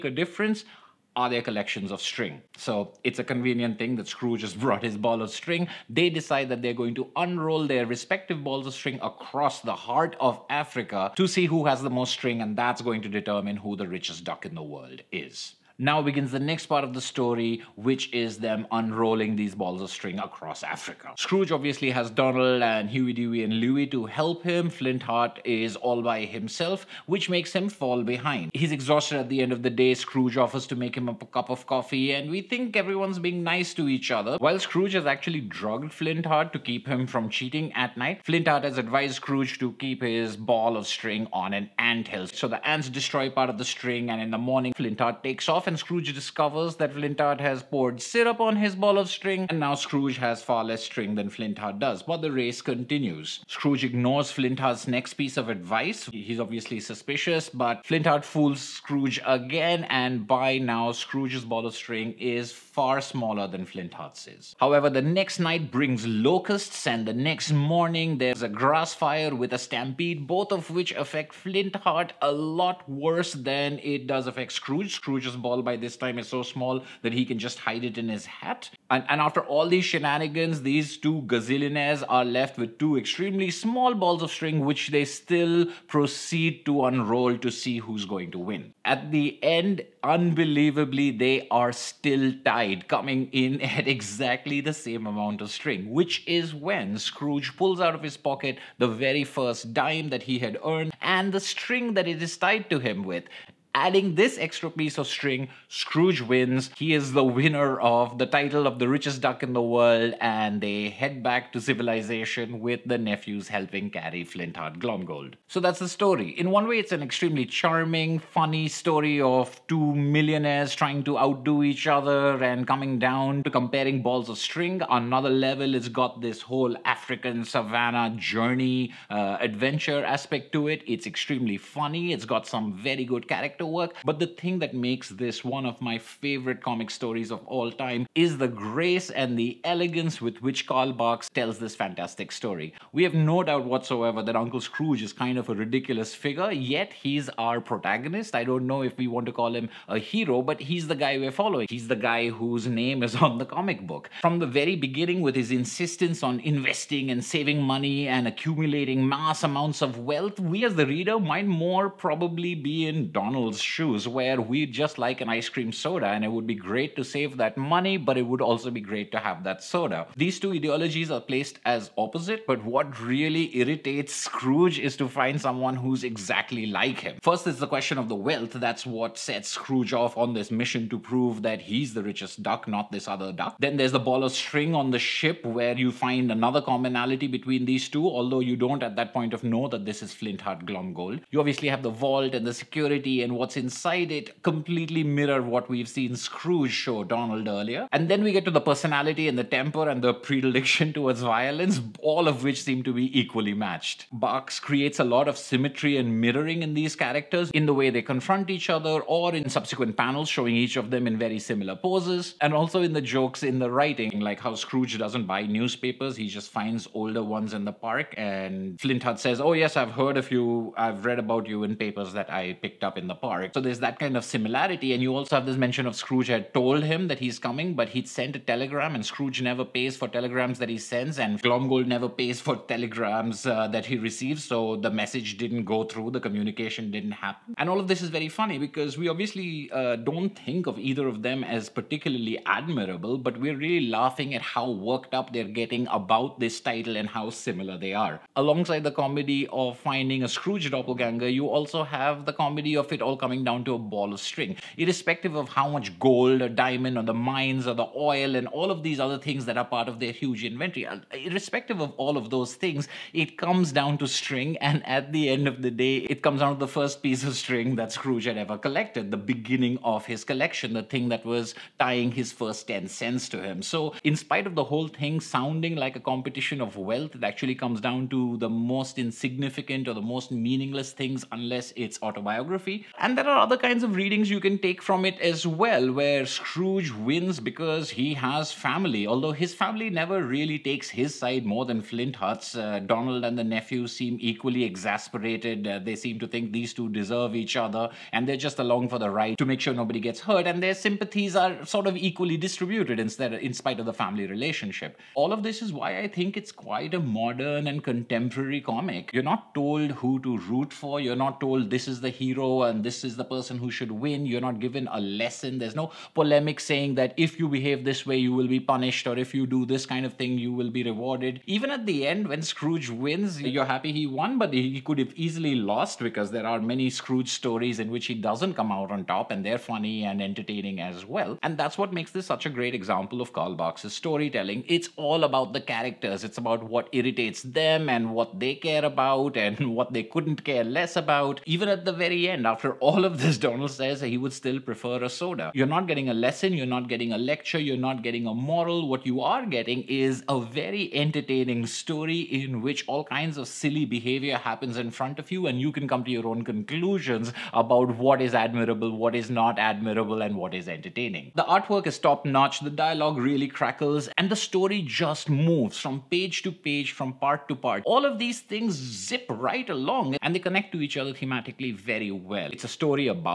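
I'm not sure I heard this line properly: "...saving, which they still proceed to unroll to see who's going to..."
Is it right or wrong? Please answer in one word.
wrong.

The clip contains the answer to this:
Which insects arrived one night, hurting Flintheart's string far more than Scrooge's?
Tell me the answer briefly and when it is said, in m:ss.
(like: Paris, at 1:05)
Locusts, at 1:06.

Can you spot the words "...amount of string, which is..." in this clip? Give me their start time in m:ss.
1:35.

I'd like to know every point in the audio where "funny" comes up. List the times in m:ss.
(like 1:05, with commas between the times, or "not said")
1:58, 2:11, 3:58, 5:29.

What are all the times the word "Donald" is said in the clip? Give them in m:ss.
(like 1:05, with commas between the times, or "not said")
0:22, 2:43, 3:17, 4:52, 5:43.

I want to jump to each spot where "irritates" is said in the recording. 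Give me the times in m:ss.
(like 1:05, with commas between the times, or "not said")
2:53, 5:36.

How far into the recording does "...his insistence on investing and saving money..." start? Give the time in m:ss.
2:35.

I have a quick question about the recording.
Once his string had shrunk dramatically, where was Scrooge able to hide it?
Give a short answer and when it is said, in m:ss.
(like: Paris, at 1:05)
In his hat, at 1:17.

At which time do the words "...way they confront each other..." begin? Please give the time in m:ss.
3:27.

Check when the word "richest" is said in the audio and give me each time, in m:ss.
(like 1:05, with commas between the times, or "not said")
0:13, 1:48, 3:02.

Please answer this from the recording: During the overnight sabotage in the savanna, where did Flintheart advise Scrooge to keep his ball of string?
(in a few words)
On an ant hill.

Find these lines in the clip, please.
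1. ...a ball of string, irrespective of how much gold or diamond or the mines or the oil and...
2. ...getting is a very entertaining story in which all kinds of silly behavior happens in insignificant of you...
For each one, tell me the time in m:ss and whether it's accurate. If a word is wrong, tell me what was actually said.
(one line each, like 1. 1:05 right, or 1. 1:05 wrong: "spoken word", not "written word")
1. 4:13 right
2. 5:49 wrong: "front", not "insignificant".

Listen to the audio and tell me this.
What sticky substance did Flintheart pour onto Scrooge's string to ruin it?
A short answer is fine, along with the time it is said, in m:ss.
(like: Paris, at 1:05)
Syrup, at 0:48.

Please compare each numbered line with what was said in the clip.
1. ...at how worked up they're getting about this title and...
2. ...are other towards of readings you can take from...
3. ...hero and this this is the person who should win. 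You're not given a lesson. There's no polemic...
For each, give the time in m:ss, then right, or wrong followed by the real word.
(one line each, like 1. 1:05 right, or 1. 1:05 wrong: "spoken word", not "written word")
1. 4:04 right
2. 4:43 wrong: "kinds", not "towards"
3. 5:12 right.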